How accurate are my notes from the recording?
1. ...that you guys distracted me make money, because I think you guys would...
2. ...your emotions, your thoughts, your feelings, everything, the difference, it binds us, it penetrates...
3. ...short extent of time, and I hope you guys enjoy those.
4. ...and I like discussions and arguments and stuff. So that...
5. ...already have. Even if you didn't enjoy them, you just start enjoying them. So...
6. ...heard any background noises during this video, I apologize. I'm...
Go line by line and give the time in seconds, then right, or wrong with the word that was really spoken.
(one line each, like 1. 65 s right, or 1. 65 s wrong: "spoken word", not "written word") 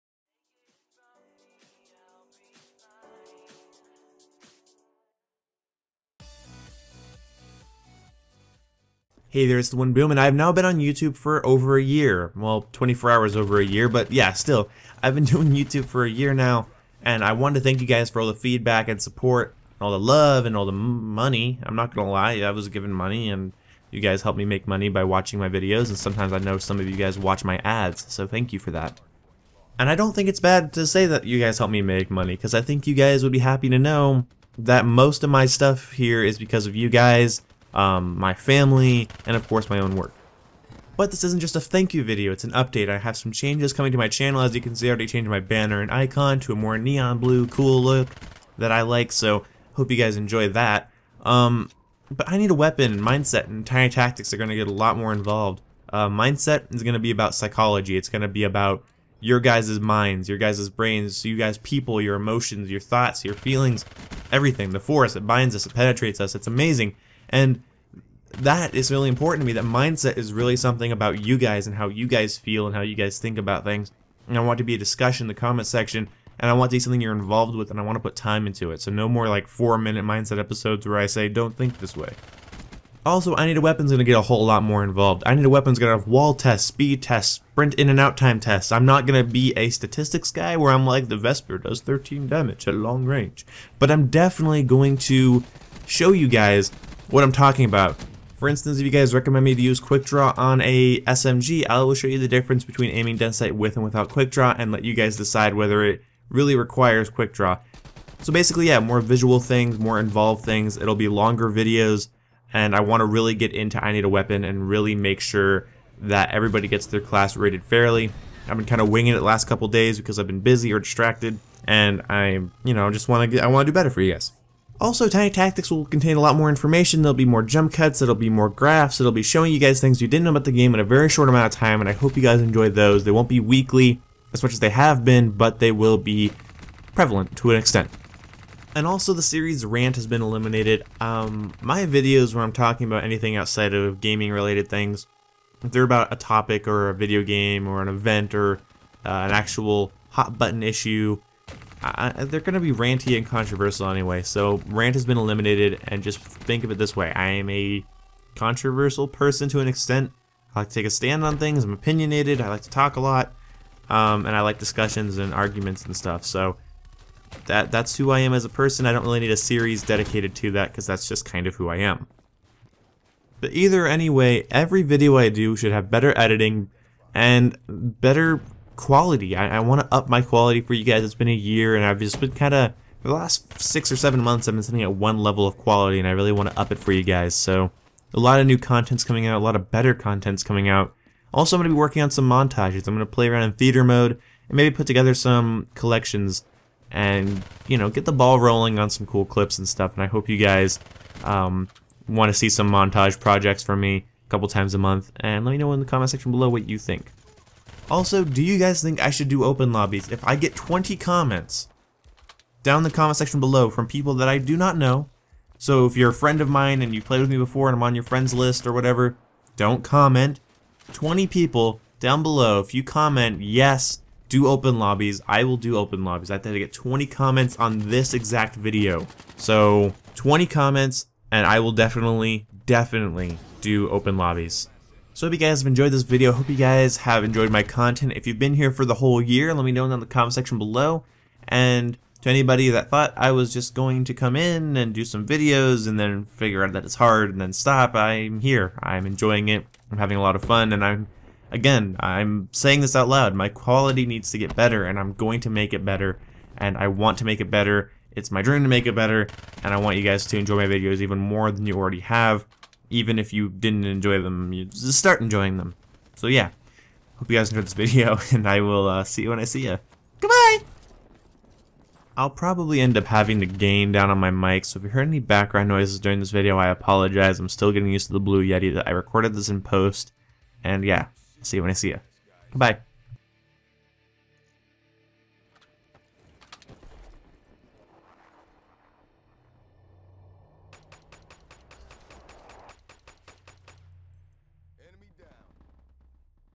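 1. 31 s wrong: "helped", not "distracted"
2. 62 s wrong: "force", not "difference"
3. 131 s wrong: "amount", not "extent"
4. 164 s right
5. 261 s right
6. 274 s right.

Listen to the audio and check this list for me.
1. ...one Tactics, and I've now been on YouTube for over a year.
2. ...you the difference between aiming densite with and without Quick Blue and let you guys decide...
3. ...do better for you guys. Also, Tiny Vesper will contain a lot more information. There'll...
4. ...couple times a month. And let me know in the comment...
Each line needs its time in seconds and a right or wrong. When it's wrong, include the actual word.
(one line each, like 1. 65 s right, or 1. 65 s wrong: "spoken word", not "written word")
1. 9 s wrong: "Boom", not "Tactics"
2. 102 s wrong: "Draw", not "Blue"
3. 123 s wrong: "Tactics", not "Vesper"
4. 204 s right.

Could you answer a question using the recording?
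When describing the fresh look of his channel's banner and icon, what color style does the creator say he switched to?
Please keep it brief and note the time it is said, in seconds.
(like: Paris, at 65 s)
neon blue, at 46 s.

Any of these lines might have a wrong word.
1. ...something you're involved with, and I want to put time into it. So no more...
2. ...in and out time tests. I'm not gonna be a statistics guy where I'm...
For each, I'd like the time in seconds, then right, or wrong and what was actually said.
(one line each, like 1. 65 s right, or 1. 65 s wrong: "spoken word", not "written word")
1. 76 s right
2. 87 s right.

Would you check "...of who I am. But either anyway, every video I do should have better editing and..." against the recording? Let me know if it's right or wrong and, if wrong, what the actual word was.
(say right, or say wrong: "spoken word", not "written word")
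right.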